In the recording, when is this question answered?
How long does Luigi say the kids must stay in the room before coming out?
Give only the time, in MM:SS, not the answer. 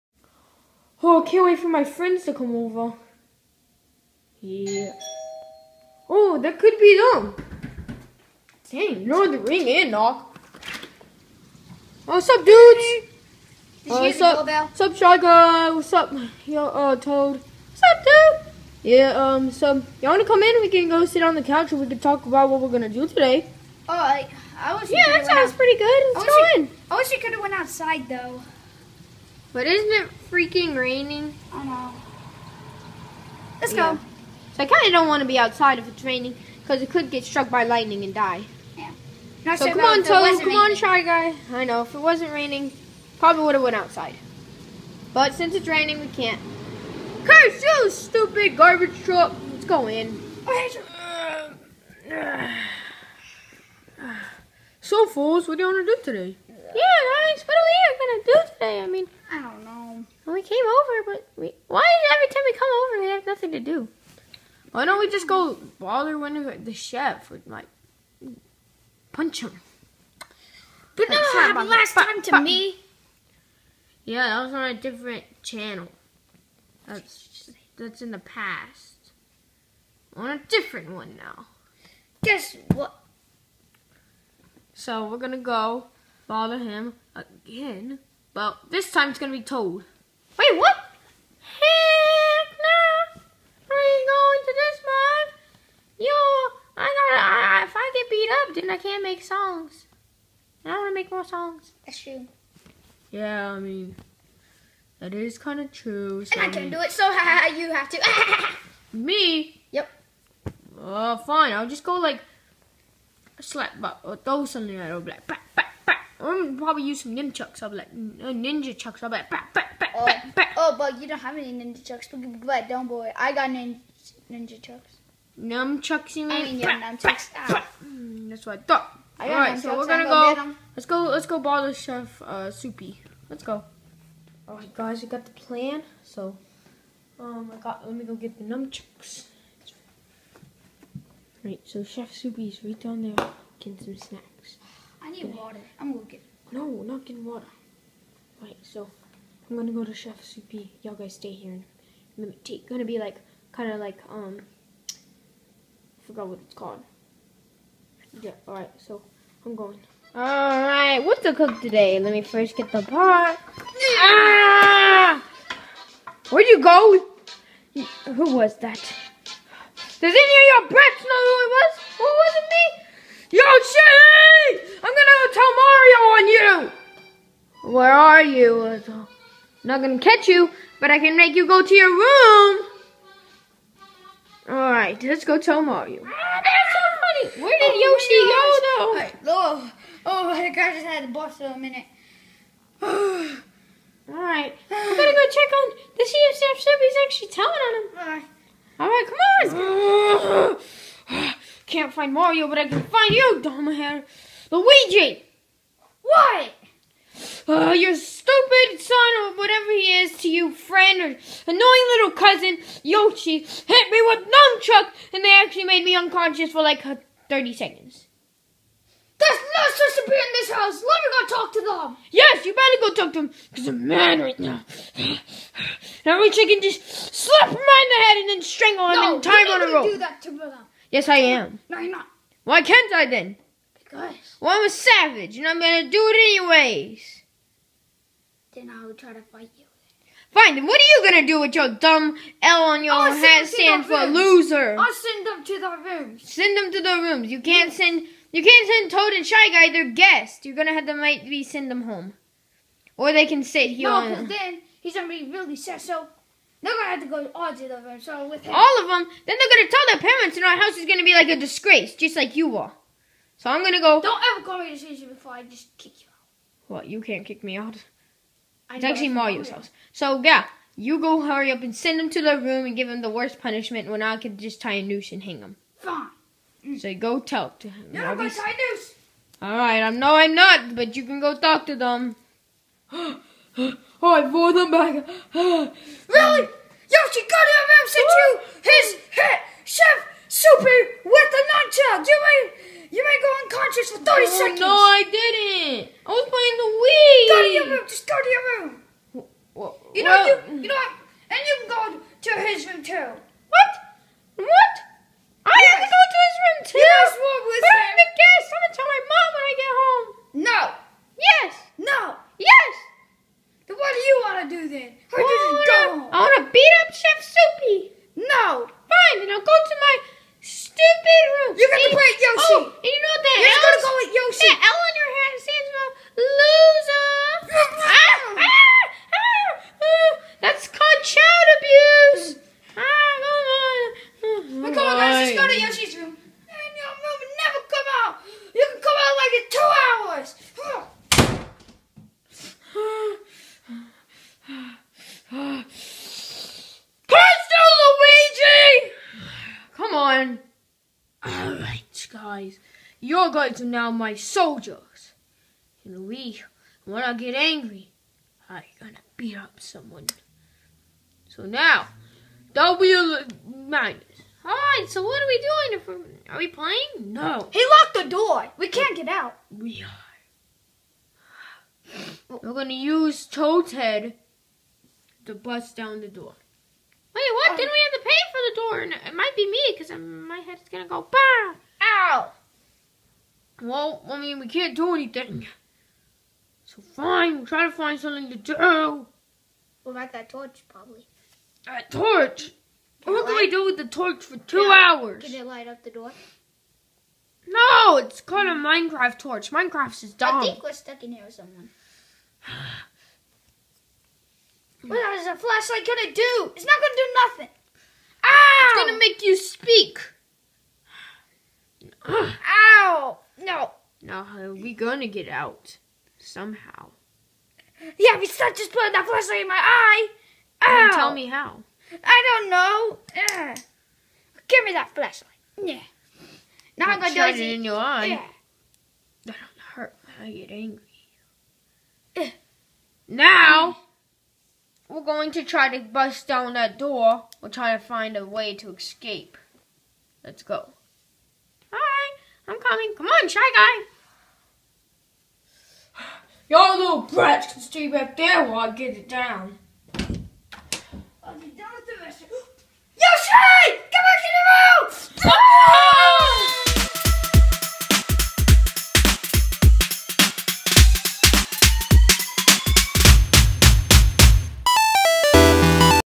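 05:39.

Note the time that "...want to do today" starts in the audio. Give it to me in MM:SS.
00:55.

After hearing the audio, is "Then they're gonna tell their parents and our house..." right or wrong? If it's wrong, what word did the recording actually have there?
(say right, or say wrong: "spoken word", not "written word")
right.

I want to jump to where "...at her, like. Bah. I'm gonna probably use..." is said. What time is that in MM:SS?
01:54.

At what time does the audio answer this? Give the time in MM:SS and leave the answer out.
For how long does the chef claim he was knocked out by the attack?
03:37.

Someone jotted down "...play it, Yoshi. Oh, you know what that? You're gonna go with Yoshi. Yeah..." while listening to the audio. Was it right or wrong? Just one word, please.
right.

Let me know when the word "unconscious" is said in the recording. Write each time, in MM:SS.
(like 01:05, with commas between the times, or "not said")
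03:35, 04:53.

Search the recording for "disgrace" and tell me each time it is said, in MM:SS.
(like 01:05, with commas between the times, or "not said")
04:21.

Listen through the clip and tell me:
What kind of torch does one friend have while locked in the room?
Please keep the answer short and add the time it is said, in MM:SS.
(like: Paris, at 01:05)
Minecraft torch, at 06:38.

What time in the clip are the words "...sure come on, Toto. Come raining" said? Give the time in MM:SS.
00:39.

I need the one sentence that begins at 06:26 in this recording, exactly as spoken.
So fine, we'll try to find something to do.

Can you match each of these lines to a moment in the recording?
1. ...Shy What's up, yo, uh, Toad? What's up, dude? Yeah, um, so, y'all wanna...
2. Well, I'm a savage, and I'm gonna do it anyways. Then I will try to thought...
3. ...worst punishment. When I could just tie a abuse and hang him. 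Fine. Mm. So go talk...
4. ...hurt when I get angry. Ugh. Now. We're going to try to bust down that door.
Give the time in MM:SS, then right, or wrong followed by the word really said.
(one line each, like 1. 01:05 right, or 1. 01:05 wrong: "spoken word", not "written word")
1. 00:14 right
2. 03:54 wrong: "fight", not "thought"
3. 04:33 wrong: "noose", not "abuse"
4. 07:09 right.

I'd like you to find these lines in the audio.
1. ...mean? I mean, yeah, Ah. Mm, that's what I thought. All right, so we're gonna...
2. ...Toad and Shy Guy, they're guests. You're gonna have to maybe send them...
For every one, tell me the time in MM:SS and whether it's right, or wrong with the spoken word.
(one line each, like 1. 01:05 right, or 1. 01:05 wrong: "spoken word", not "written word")
1. 02:06 right
2. 04:08 right.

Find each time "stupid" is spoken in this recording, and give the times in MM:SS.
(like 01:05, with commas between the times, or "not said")
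00:47, 03:27.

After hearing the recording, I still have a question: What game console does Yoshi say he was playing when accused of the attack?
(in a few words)
Wii.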